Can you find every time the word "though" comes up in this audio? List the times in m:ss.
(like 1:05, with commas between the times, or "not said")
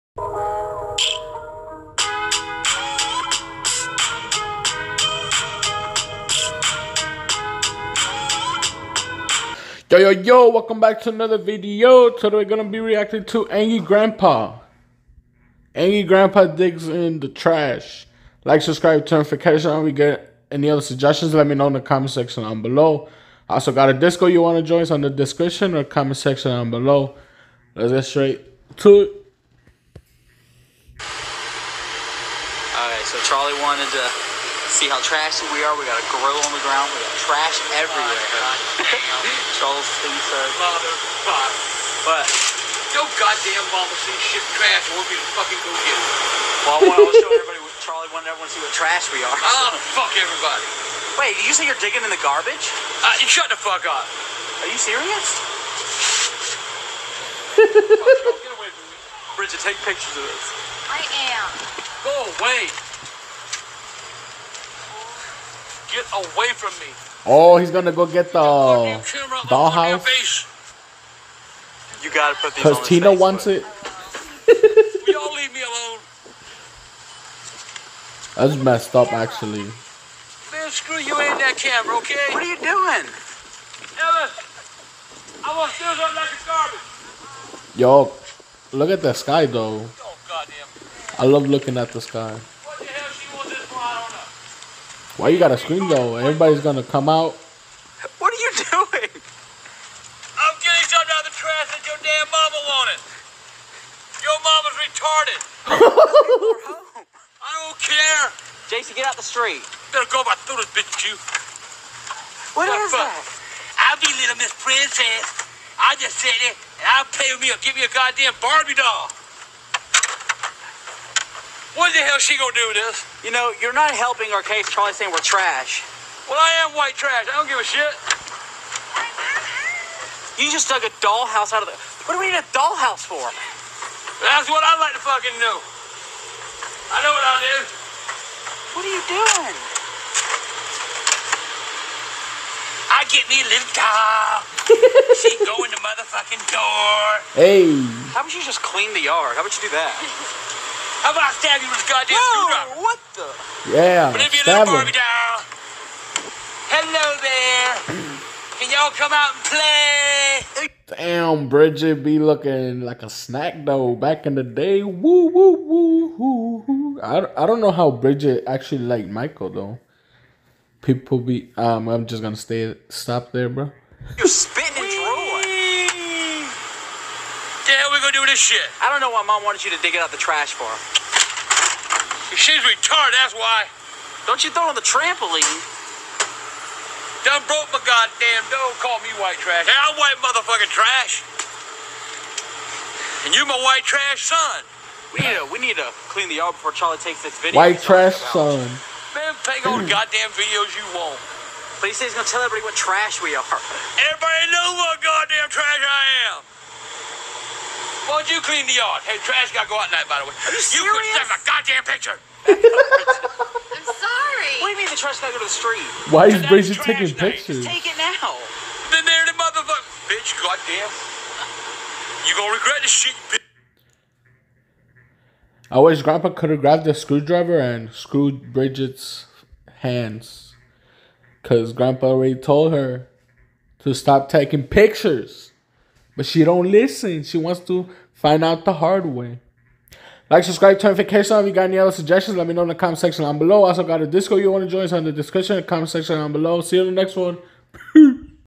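1:29, 1:35, 2:43, 2:49.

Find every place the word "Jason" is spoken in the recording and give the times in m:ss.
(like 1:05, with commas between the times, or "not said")
1:48.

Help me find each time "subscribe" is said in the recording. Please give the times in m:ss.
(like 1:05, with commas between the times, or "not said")
0:18, 4:00.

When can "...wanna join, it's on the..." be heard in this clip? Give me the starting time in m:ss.
0:24.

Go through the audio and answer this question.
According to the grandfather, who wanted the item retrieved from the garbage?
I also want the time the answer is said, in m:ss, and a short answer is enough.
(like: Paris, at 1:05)
Tina, at 1:12.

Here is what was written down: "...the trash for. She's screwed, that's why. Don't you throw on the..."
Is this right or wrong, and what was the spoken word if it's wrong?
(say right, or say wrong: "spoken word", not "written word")
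wrong: "retarded", not "screwed".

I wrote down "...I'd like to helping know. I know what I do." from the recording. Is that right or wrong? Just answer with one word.
wrong.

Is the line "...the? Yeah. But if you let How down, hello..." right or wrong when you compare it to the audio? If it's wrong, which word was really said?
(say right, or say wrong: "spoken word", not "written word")
wrong: "Barbie", not "How".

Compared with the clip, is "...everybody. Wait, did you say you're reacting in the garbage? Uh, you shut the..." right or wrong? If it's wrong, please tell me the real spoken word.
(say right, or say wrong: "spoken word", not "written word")
wrong: "digging", not "reacting".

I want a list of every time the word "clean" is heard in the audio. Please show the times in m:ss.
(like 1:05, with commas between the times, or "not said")
2:28, 3:16, 3:28.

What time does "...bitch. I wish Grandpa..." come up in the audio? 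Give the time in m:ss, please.
3:43.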